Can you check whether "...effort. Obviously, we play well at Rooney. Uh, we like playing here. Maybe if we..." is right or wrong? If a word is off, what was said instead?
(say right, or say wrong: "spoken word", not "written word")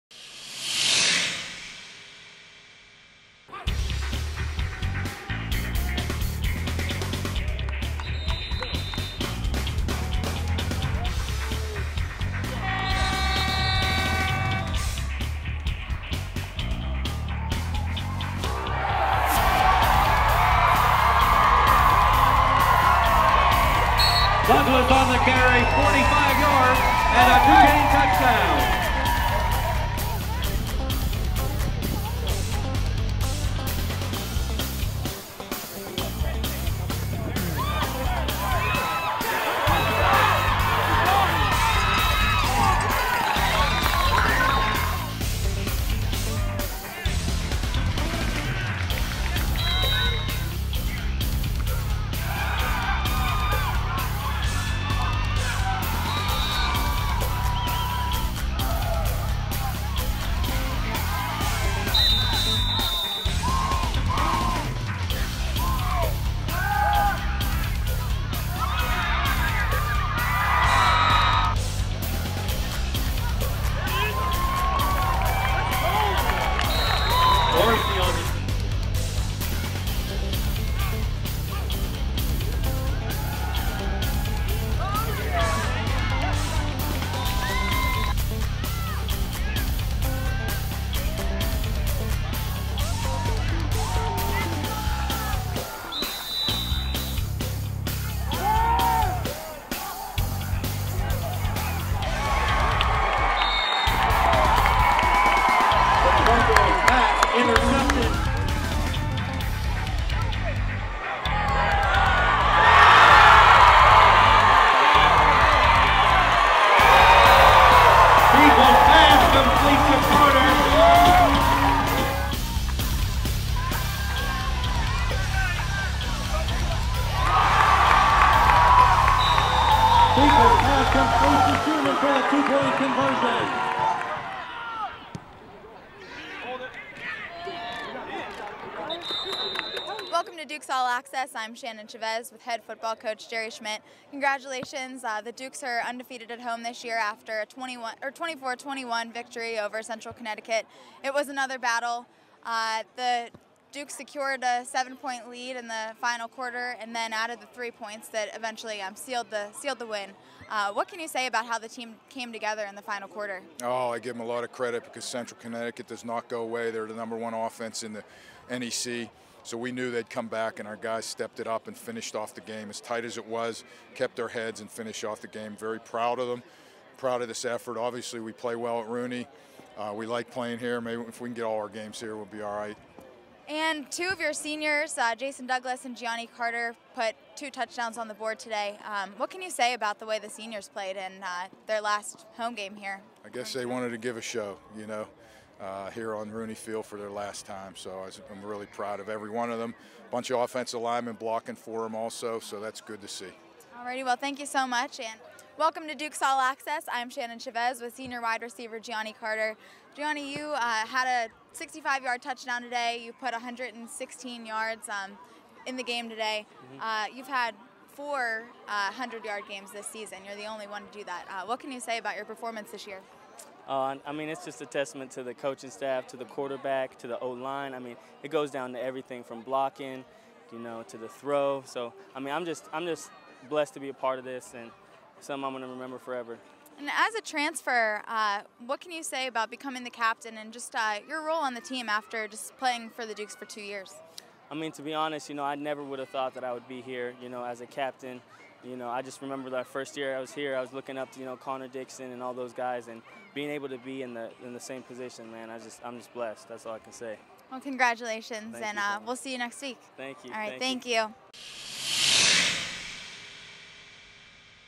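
right.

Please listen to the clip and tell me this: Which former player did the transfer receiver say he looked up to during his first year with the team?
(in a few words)
Connor Dixon.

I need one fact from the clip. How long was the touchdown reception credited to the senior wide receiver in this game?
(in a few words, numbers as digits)
65 yards.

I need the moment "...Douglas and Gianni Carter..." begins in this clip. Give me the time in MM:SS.
03:05.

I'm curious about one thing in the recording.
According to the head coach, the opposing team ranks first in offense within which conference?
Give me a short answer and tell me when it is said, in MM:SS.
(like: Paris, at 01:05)
NEC, at 02:48.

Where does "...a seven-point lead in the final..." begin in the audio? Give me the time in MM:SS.
02:34.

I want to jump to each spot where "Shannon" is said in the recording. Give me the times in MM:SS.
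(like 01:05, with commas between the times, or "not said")
02:21, 03:27.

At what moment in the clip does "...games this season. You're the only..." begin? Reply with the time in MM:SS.
03:39.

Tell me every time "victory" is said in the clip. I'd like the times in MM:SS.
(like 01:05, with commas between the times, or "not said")
02:29.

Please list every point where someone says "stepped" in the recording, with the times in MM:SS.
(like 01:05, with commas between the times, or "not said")
02:51.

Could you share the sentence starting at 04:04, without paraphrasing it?
I mean, to be honest, you know, I never would have thought that I would be here, you know, as a captain.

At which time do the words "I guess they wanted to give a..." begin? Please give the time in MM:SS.
03:13.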